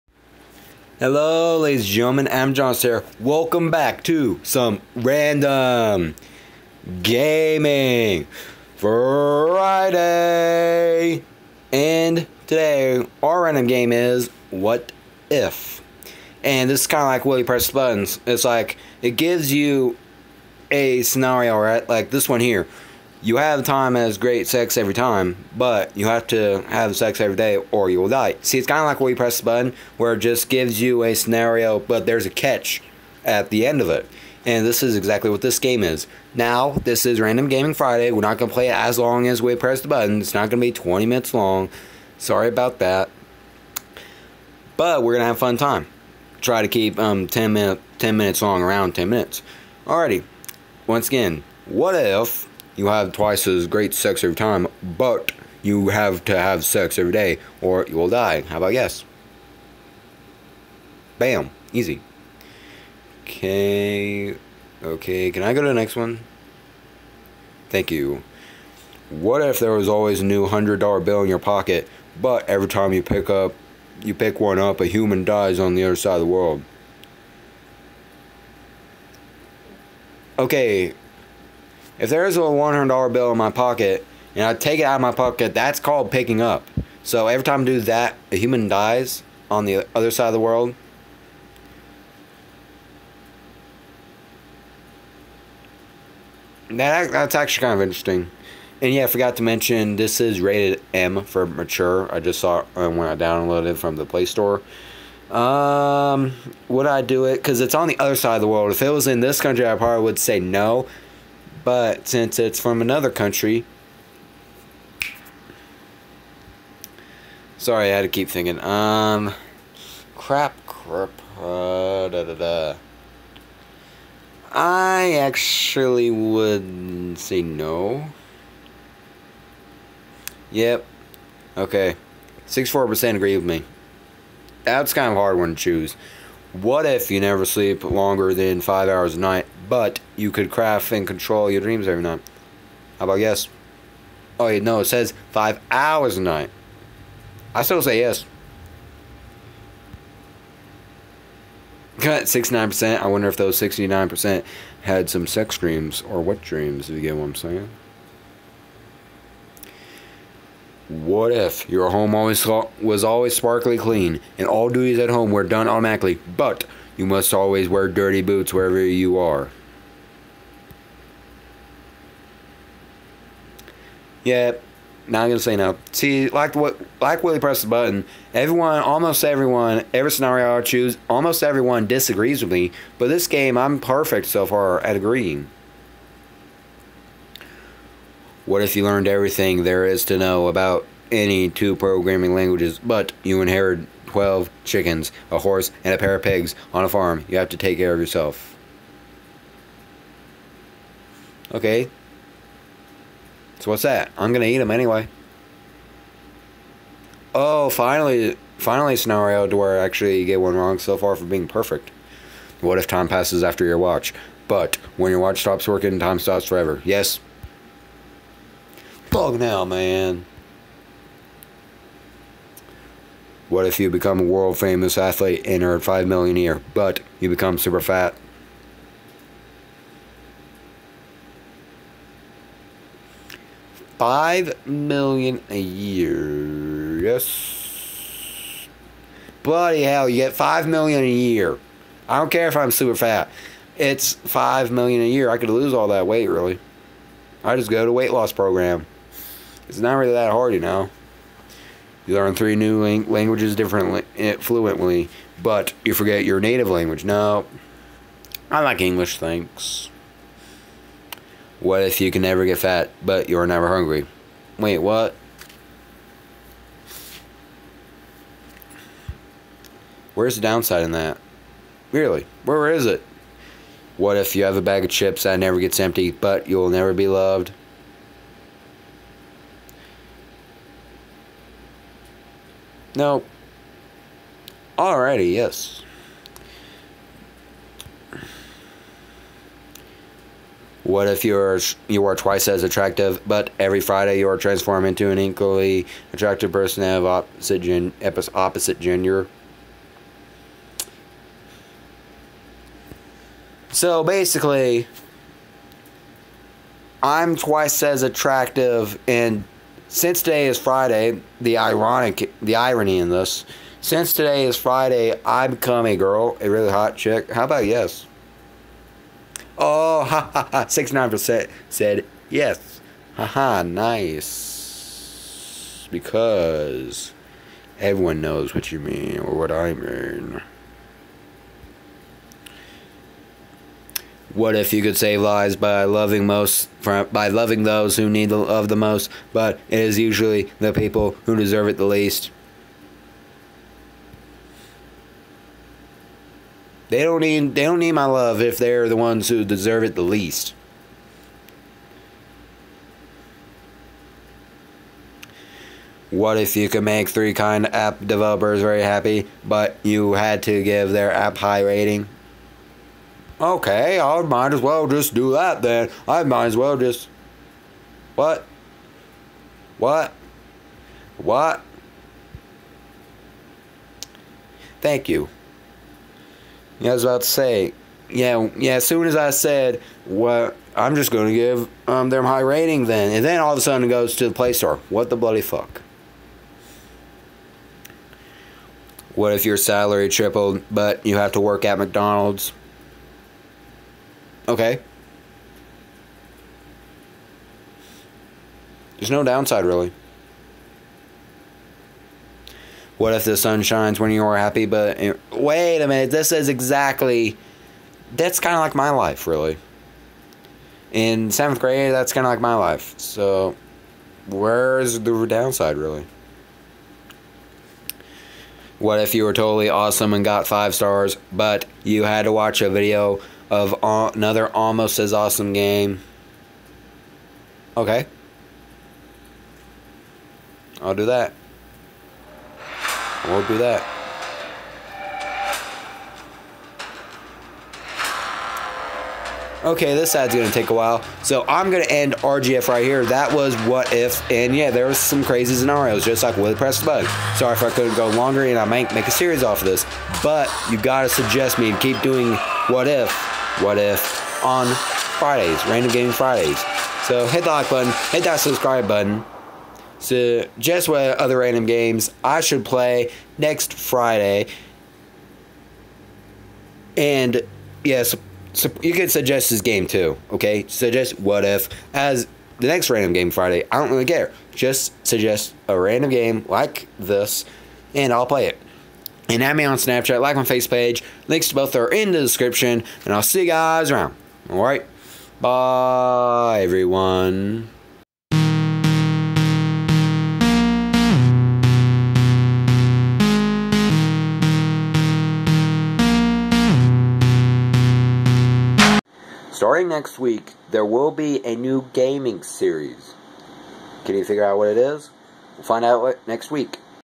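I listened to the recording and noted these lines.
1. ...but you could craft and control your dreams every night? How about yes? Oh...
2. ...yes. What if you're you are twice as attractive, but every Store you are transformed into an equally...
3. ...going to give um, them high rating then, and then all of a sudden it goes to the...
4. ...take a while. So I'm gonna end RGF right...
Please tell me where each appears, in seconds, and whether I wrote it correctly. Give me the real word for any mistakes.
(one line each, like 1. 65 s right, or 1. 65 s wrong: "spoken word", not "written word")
1. 139 s right
2. 285 s wrong: "Friday", not "Store"
3. 381 s right
4. 440 s right.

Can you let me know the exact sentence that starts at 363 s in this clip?
Okay, I might as well just do that then.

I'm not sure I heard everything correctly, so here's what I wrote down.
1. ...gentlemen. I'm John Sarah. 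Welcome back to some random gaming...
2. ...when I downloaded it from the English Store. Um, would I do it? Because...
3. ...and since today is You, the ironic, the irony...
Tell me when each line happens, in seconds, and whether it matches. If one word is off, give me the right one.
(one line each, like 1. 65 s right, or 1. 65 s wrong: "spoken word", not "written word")
1. 1 s right
2. 102 s wrong: "Play", not "English"
3. 309 s wrong: "Friday", not "You".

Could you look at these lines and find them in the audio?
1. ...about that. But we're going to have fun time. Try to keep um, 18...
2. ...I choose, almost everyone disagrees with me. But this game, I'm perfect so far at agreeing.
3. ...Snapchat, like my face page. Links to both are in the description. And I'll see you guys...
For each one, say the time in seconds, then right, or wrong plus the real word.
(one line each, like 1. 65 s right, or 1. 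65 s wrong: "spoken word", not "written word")
1. 42 s wrong: "10", not "18"
2. 180 s right
3. 479 s right.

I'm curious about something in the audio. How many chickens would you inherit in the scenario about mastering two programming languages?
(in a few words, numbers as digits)
12.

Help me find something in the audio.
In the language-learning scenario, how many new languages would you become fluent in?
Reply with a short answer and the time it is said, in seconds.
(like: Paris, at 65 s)
3, at 252 s.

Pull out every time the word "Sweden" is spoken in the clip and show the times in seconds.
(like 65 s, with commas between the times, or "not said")
not said.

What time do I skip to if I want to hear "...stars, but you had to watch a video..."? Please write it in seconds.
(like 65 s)
420 s.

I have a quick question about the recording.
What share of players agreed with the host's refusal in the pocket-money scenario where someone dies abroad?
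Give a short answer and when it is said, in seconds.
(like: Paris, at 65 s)
64%, at 132 s.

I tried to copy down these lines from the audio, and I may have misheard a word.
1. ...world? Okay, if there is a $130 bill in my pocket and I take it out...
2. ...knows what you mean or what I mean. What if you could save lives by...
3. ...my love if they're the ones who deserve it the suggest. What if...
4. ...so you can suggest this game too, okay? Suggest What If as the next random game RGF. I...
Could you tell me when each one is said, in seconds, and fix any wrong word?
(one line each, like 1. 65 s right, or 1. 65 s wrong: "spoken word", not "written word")
1. 76 s wrong: "100", not "130"
2. 328 s right
3. 347 s wrong: "least", not "suggest"
4. 468 s wrong: "Friday", not "RGF".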